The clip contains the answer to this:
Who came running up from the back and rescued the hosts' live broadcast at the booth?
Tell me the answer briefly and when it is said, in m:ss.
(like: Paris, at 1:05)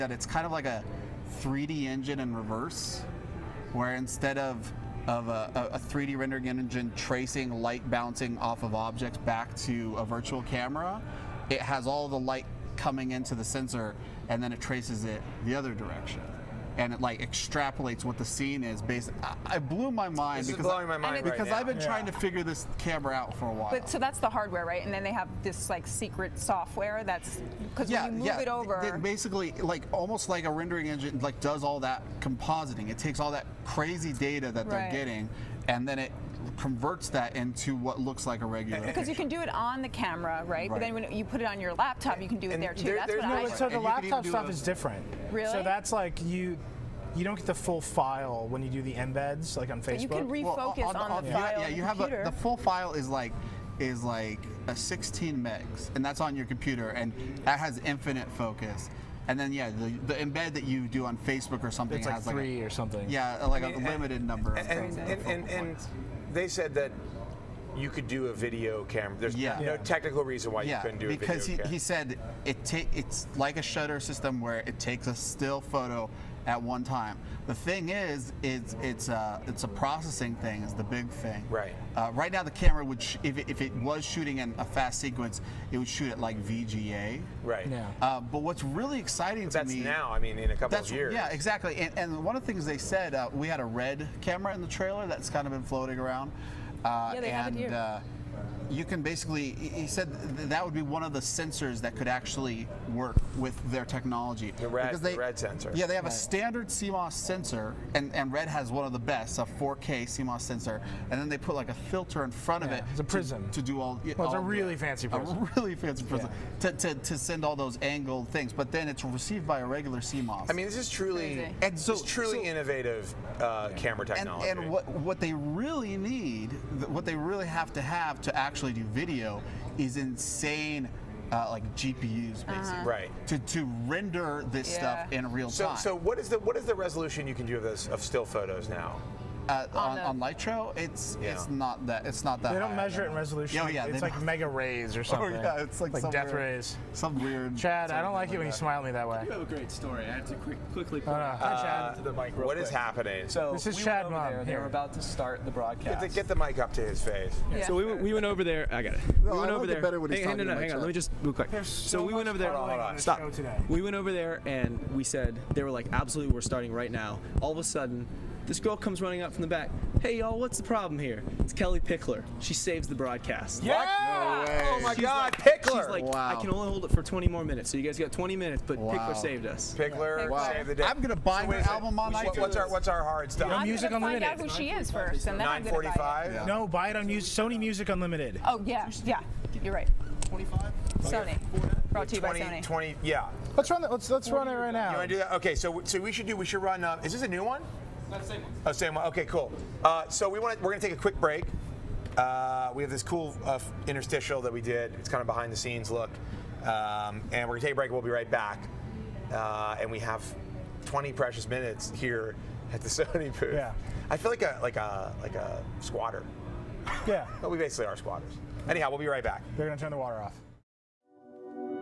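Kellie Pickler, at 2:51.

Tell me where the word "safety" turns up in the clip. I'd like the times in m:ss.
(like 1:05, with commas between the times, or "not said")
not said.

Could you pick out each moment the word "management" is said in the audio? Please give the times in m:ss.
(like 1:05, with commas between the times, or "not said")
not said.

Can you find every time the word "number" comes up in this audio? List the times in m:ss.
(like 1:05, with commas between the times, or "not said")
1:04.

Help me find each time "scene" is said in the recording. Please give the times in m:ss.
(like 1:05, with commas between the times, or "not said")
0:18, 3:25.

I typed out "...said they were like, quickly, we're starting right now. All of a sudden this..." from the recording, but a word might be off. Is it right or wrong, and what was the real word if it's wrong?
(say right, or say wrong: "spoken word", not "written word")
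wrong: "absolutely", not "quickly".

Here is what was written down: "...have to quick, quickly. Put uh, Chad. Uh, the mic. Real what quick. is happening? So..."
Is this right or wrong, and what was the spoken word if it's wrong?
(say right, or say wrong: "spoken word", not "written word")
right.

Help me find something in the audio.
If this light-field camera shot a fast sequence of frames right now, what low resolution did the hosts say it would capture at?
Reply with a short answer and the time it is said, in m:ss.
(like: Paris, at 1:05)
VGA, at 1:26.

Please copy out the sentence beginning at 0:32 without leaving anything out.
It takes all that crazy data that right.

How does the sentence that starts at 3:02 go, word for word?
What's our what's our hard stuff?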